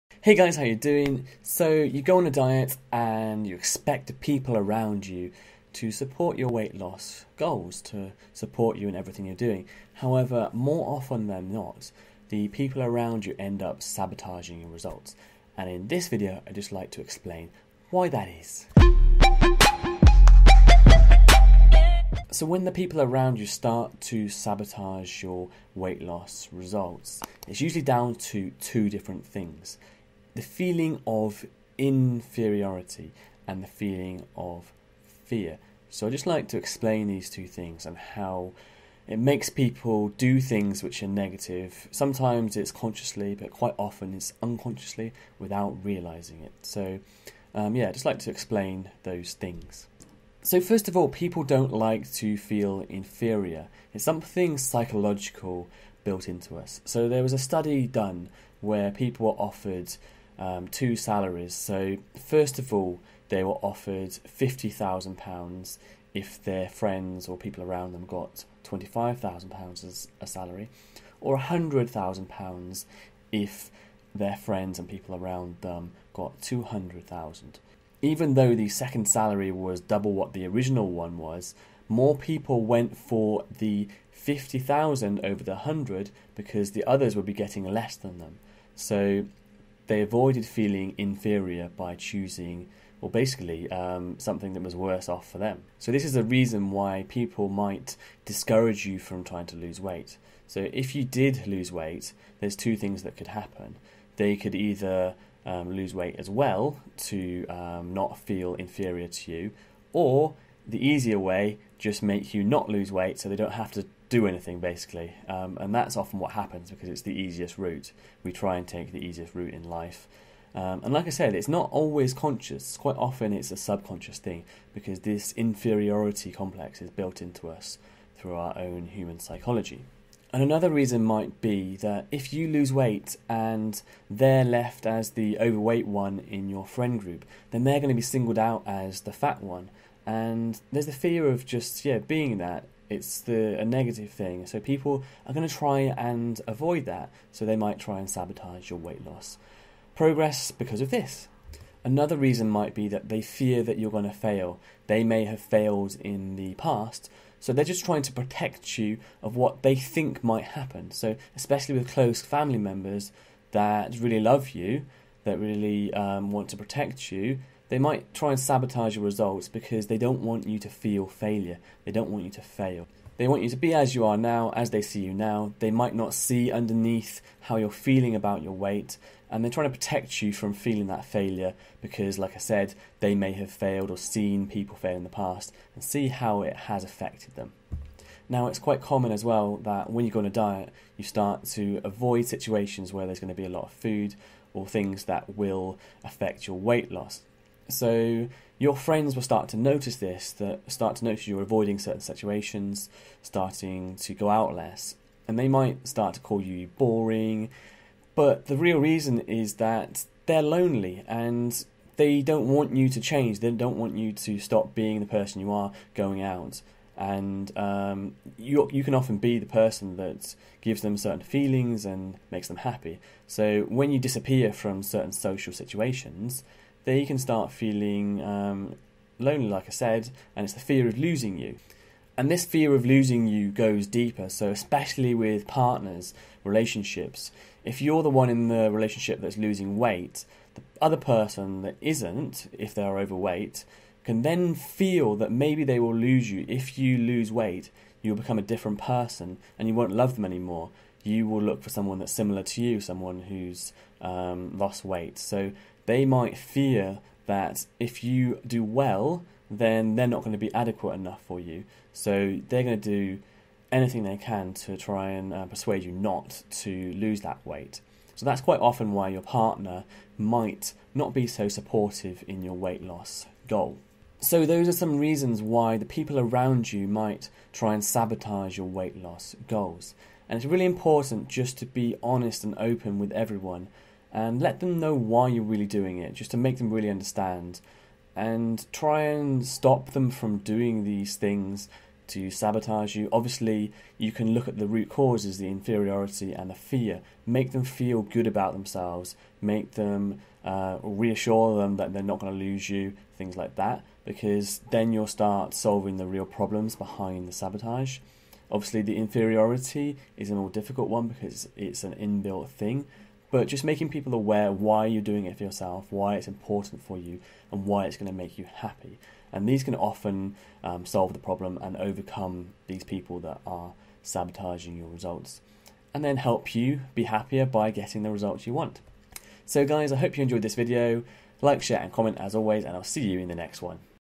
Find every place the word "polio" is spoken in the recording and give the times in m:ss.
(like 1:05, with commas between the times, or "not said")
not said.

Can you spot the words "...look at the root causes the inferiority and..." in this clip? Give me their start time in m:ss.
4:54.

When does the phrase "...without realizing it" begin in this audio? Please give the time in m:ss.
0:45.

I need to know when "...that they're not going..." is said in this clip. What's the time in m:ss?
5:01.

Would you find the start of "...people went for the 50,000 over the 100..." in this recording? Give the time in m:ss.
1:22.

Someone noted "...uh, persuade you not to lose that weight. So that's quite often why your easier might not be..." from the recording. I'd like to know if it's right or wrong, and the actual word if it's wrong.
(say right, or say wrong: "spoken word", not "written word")
wrong: "partner", not "easier".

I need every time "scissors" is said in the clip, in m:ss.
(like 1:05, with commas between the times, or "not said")
not said.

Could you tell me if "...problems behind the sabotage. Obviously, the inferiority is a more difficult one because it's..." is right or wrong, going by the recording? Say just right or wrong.
right.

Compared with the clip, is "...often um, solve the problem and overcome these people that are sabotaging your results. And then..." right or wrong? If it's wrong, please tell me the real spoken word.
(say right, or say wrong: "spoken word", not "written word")
right.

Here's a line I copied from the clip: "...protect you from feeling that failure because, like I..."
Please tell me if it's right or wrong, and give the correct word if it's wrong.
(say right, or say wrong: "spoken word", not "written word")
right.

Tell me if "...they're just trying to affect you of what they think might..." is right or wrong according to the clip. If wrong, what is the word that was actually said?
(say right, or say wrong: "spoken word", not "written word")
wrong: "protect", not "affect".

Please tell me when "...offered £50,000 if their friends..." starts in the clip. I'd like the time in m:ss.
1:03.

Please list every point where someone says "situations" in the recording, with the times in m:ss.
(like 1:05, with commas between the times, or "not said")
3:12, 3:22, 3:45.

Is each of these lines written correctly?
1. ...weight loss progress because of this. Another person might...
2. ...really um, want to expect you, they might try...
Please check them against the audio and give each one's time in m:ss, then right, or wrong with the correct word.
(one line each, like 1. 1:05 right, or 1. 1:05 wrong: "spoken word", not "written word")
1. 2:28 wrong: "reason", not "person"
2. 2:45 wrong: "protect", not "expect".